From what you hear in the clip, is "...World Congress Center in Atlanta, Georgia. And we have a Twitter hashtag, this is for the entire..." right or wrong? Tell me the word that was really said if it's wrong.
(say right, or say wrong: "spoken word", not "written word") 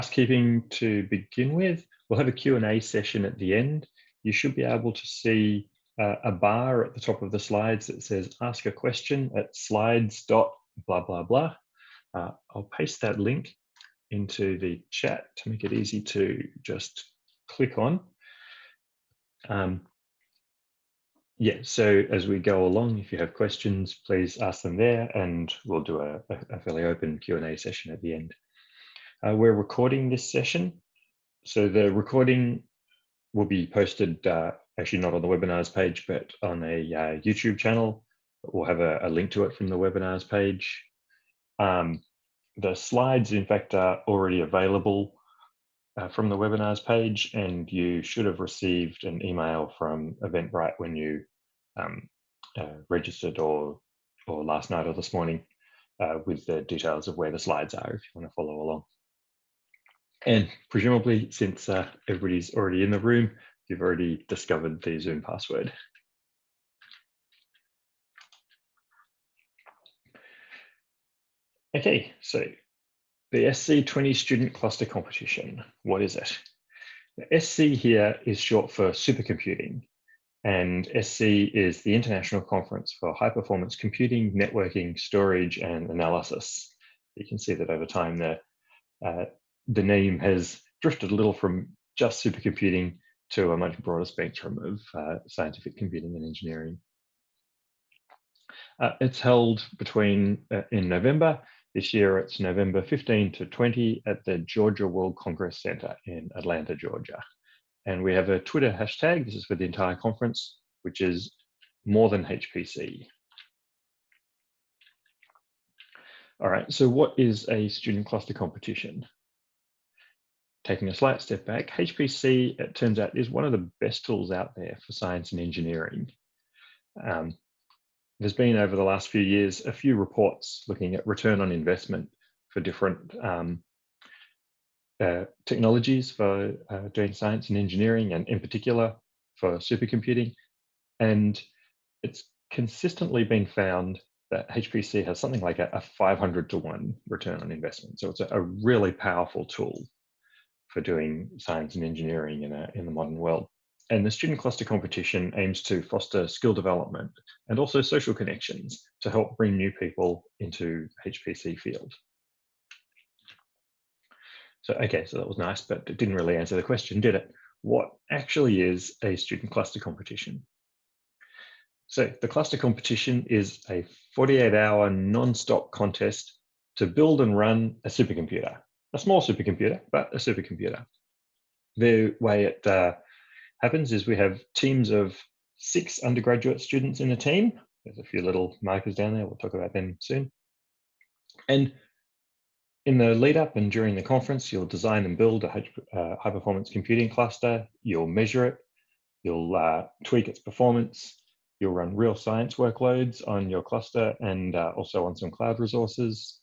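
right.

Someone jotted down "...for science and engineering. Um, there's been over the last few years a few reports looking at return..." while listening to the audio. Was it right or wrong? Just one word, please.
right.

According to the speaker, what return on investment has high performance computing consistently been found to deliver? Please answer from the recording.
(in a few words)
500 to 1.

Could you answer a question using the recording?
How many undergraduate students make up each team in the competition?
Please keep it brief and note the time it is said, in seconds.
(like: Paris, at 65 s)
6, at 185 s.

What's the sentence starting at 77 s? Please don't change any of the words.
The SC here is short for supercomputing, and SC is the International Conference for High Performance Computing, Networking, Storage, and Analysis.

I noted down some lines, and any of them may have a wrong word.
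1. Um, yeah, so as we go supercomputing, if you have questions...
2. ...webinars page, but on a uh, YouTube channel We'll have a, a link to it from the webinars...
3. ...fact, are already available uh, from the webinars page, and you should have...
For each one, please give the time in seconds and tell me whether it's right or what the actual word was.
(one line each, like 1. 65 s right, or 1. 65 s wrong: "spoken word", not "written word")
1. 19 s wrong: "along", not "supercomputing"
2. 35 s right
3. 43 s right.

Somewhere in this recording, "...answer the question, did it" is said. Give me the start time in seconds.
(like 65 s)
166 s.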